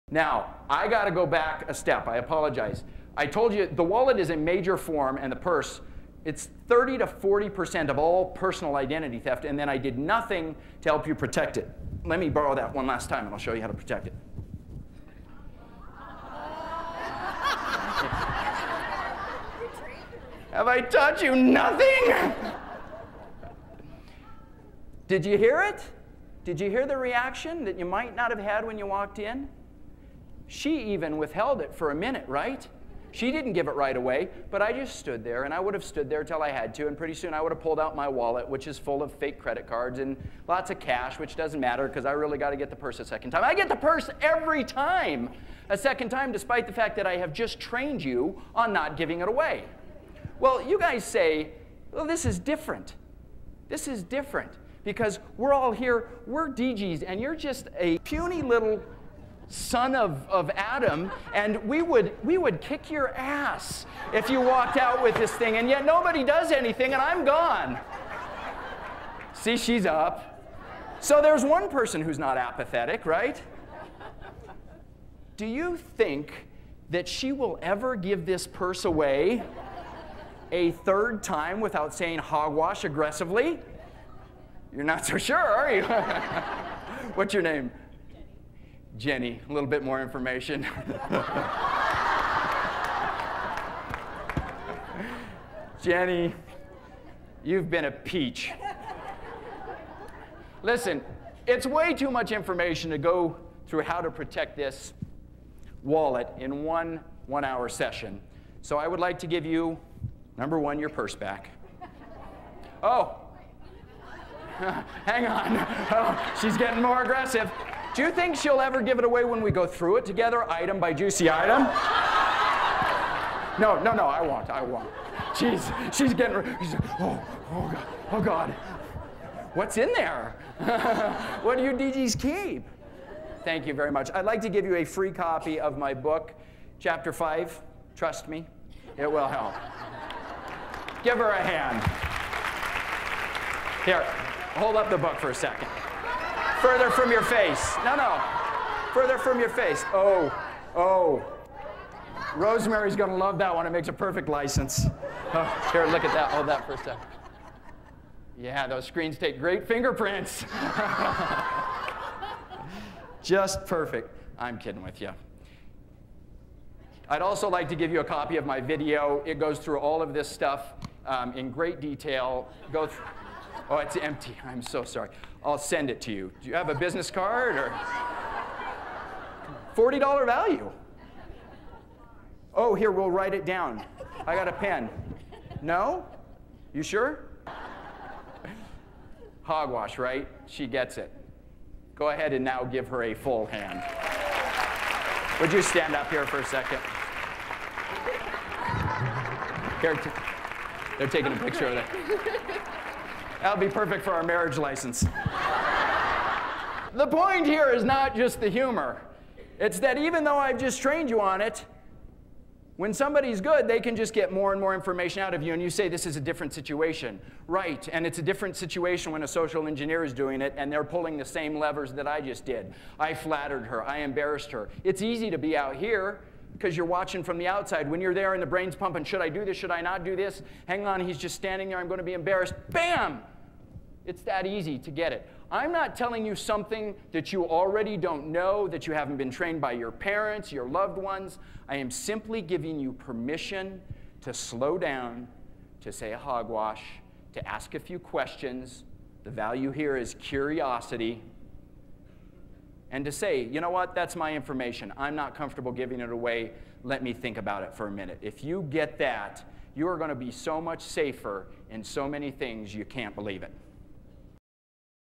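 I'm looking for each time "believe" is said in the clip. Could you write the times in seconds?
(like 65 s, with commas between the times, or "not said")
263 s.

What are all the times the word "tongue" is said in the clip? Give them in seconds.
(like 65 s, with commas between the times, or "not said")
not said.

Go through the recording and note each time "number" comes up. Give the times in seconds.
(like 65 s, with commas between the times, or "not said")
110 s.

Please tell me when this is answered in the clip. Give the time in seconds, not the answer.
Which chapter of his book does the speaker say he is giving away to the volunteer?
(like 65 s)
136 s.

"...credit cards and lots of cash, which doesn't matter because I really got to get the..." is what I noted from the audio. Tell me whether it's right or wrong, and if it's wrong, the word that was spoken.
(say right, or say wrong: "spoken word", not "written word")
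right.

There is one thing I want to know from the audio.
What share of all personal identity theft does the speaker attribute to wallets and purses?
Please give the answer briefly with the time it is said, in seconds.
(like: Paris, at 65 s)
30 to 40%, at 6 s.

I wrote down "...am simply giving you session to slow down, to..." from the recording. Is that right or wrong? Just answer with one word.
wrong.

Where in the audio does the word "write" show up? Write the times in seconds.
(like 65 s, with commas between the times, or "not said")
183 s.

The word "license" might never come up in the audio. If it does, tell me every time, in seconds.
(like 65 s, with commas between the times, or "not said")
154 s, 204 s.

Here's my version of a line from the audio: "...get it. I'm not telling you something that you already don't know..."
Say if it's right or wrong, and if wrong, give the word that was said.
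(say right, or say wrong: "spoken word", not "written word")
right.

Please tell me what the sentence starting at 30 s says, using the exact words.
She even withheld it for a minute, right?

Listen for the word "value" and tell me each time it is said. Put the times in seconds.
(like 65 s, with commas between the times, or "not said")
180 s, 249 s.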